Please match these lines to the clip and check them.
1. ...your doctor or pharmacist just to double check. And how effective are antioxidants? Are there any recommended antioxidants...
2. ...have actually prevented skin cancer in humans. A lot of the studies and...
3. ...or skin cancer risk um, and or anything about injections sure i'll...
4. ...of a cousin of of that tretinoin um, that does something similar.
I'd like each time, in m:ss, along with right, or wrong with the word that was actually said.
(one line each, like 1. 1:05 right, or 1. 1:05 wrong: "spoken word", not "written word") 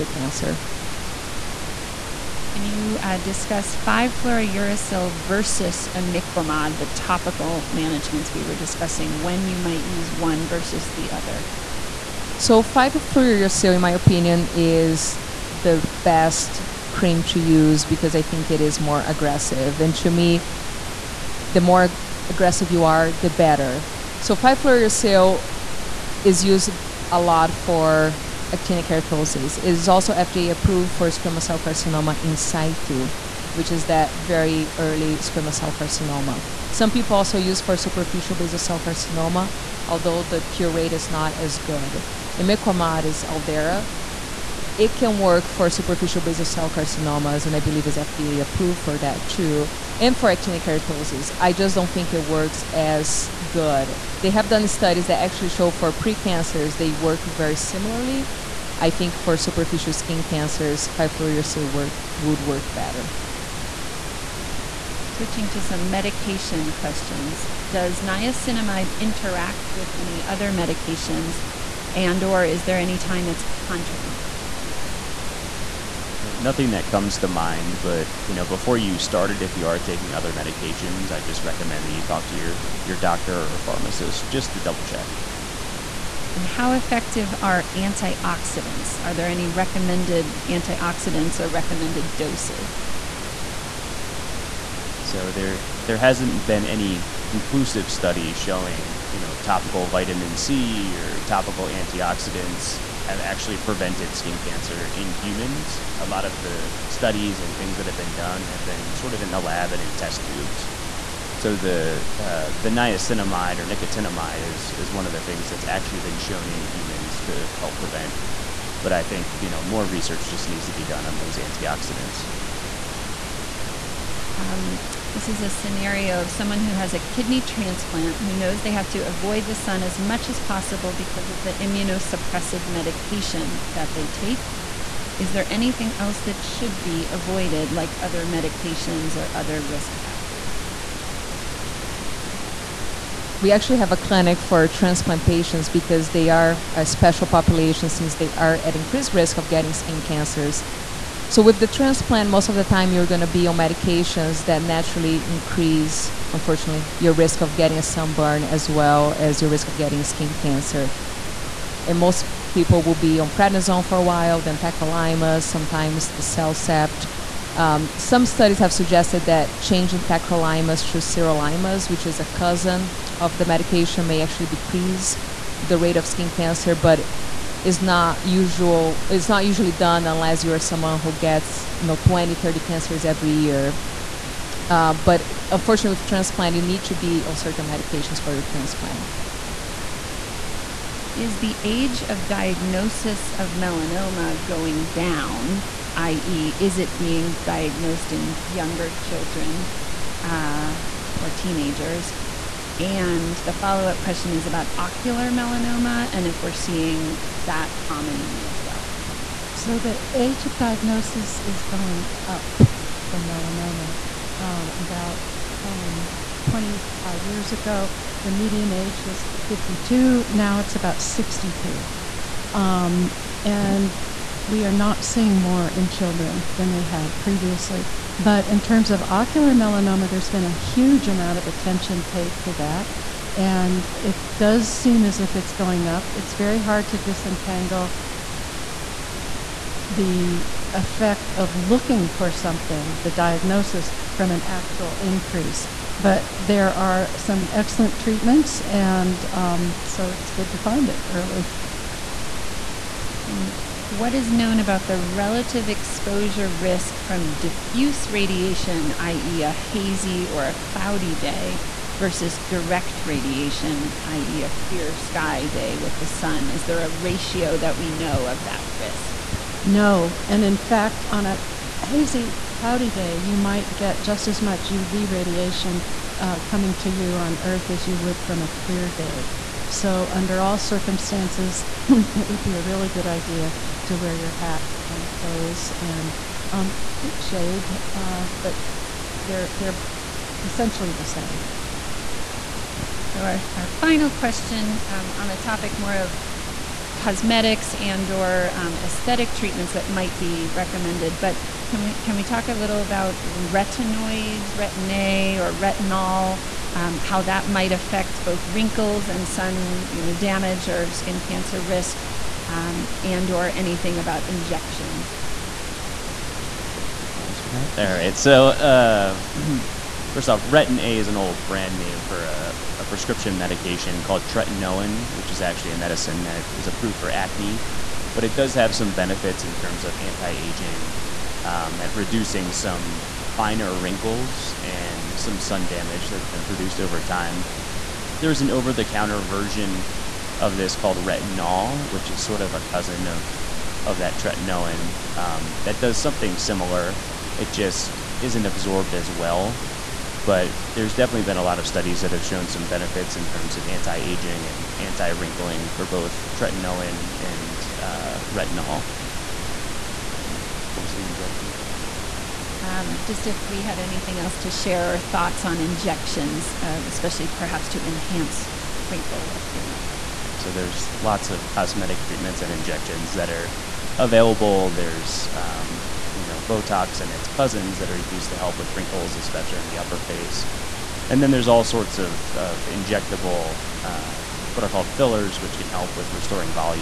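1. 1:22 right
2. 1:43 right
3. 5:10 right
4. 5:42 right.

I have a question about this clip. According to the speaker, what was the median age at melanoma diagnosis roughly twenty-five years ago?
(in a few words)
52.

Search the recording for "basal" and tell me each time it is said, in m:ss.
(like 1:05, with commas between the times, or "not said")
0:38, 0:46.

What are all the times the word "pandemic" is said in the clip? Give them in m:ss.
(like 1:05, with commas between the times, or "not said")
not said.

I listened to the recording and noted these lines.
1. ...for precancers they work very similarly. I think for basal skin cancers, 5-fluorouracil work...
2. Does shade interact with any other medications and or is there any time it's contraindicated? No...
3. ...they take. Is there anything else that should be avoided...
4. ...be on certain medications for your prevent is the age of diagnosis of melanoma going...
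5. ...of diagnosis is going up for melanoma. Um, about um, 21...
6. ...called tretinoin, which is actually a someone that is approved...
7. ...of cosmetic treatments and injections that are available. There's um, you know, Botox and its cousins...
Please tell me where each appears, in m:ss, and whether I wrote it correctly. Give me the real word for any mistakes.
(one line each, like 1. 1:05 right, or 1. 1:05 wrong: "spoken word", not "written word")
1. 0:55 wrong: "superficial", not "basal"
2. 1:07 wrong: "niacinamide", not "shade"
3. 2:13 right
4. 3:06 wrong: "transplant", not "prevent"
5. 3:30 wrong: "25", not "21"
6. 5:24 wrong: "medicine", not "someone"
7. 6:11 right.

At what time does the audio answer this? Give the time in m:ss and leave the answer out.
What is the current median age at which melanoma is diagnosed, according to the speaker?
3:41.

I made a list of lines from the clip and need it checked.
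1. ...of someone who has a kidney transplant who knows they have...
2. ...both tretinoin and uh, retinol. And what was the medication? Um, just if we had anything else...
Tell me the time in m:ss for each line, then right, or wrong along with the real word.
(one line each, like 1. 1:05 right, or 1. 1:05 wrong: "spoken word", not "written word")
1. 2:06 right
2. 5:55 wrong: "injection", not "medication".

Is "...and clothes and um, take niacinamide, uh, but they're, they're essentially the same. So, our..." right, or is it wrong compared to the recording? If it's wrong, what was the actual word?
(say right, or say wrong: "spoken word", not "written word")
wrong: "shade", not "niacinamide".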